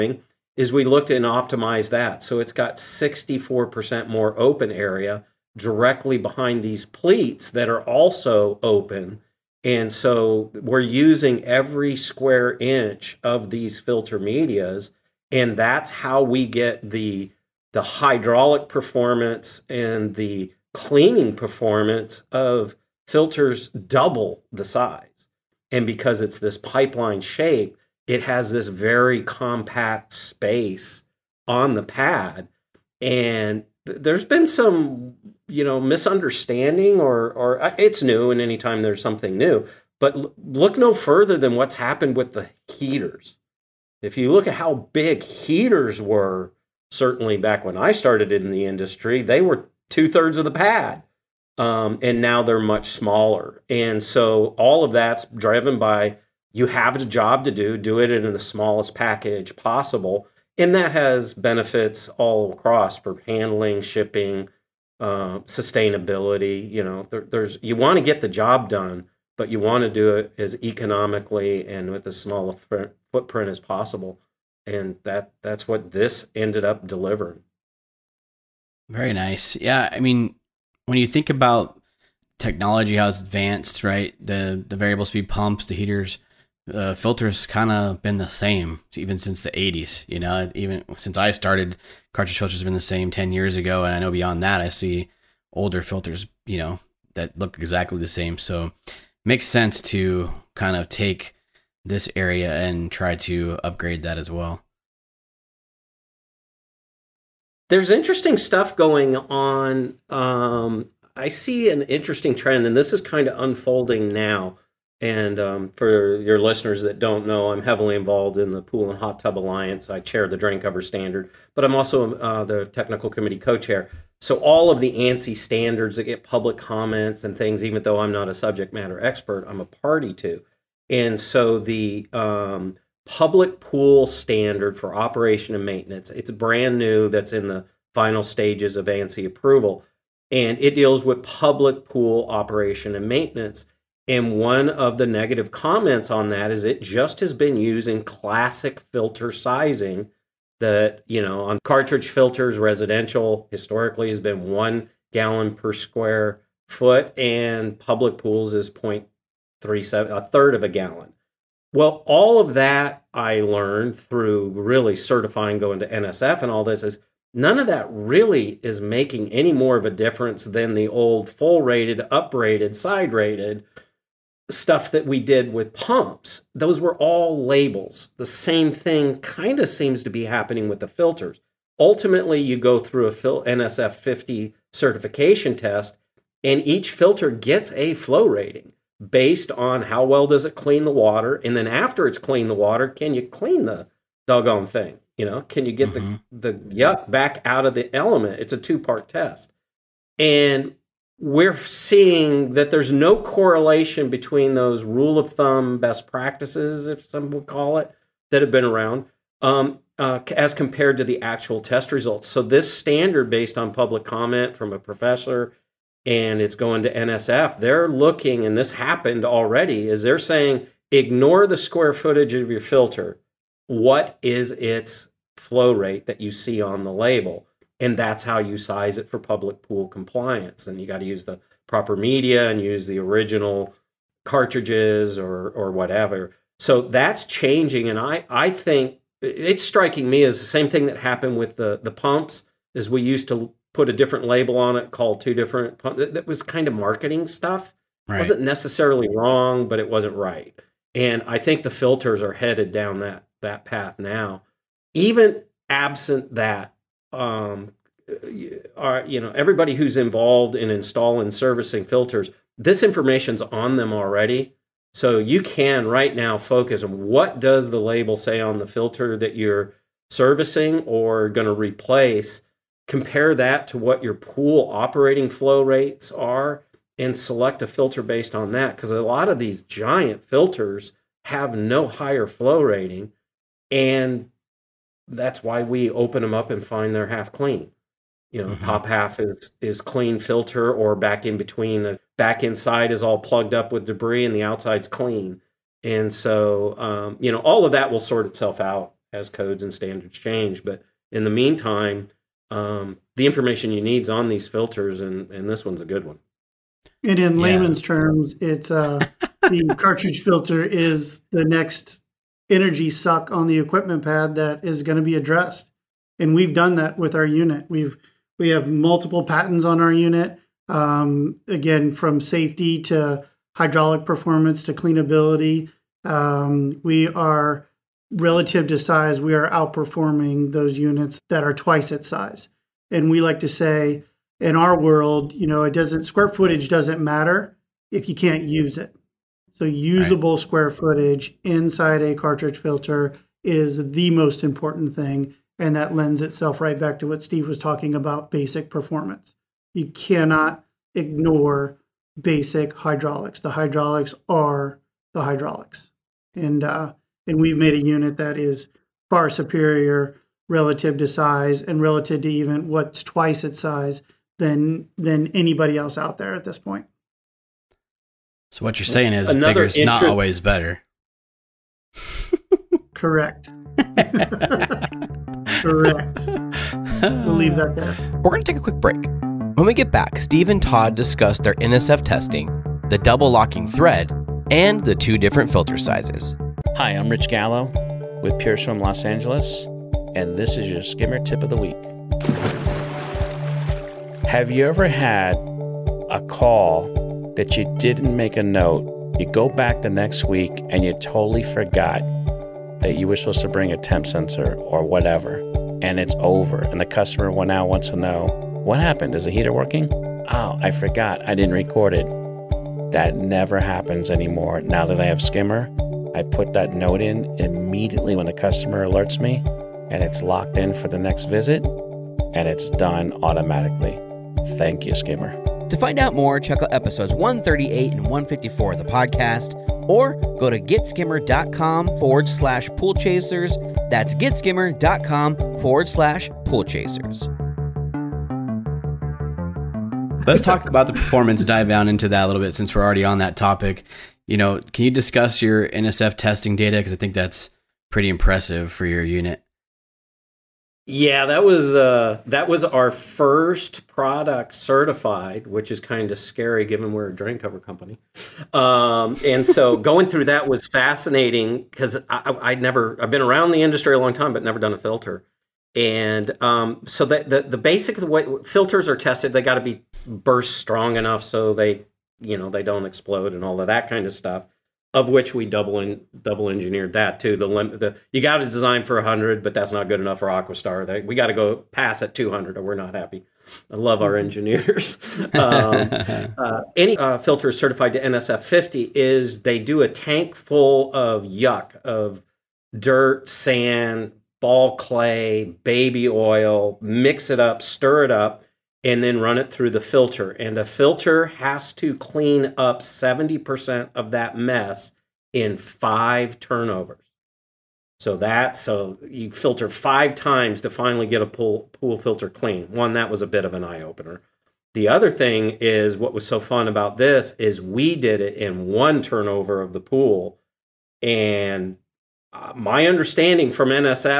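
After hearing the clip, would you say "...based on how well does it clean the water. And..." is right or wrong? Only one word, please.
right.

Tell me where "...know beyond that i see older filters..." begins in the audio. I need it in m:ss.
1:33.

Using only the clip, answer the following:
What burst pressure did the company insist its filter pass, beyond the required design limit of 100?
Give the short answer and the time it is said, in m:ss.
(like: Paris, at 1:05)
200, at 8:02.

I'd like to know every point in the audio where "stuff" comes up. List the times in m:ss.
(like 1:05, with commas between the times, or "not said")
1:48, 2:54, 4:07, 7:54.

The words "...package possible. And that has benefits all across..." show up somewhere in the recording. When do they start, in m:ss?
0:58.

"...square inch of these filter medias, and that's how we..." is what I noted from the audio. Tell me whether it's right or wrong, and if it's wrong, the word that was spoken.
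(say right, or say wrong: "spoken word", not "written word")
right.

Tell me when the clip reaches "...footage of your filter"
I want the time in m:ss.
3:41.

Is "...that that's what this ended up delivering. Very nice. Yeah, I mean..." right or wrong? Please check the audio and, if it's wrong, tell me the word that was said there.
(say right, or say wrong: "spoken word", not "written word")
right.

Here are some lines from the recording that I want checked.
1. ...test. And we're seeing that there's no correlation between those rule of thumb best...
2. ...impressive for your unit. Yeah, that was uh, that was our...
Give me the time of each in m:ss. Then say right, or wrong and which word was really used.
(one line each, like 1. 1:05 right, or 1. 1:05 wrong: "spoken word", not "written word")
1. 3:19 right
2. 7:28 right.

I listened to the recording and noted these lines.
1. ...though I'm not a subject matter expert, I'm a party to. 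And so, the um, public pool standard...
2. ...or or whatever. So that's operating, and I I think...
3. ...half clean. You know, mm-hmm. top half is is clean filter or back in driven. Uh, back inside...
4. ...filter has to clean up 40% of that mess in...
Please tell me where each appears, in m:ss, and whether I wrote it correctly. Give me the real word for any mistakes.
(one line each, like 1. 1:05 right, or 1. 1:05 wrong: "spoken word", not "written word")
1. 2:07 right
2. 3:55 wrong: "changing", not "operating"
3. 4:47 wrong: "between", not "driven"
4. 8:20 wrong: "70", not "40".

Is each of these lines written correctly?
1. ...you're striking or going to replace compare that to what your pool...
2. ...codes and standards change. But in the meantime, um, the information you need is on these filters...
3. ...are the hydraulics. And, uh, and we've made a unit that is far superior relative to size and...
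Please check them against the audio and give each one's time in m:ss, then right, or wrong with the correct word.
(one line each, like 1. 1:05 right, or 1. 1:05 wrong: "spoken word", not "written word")
1. 4:29 wrong: "servicing", not "striking"
2. 4:59 right
3. 5:54 right.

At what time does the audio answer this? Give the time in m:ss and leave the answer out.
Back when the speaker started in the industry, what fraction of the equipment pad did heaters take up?
0:49.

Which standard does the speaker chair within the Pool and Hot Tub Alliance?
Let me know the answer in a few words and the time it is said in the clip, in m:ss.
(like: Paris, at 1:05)
drain cover standard, at 2:00.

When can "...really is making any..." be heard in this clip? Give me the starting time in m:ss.
2:47.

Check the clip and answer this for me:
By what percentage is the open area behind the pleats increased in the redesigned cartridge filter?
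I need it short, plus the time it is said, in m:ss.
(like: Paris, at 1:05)
64%, at 0:02.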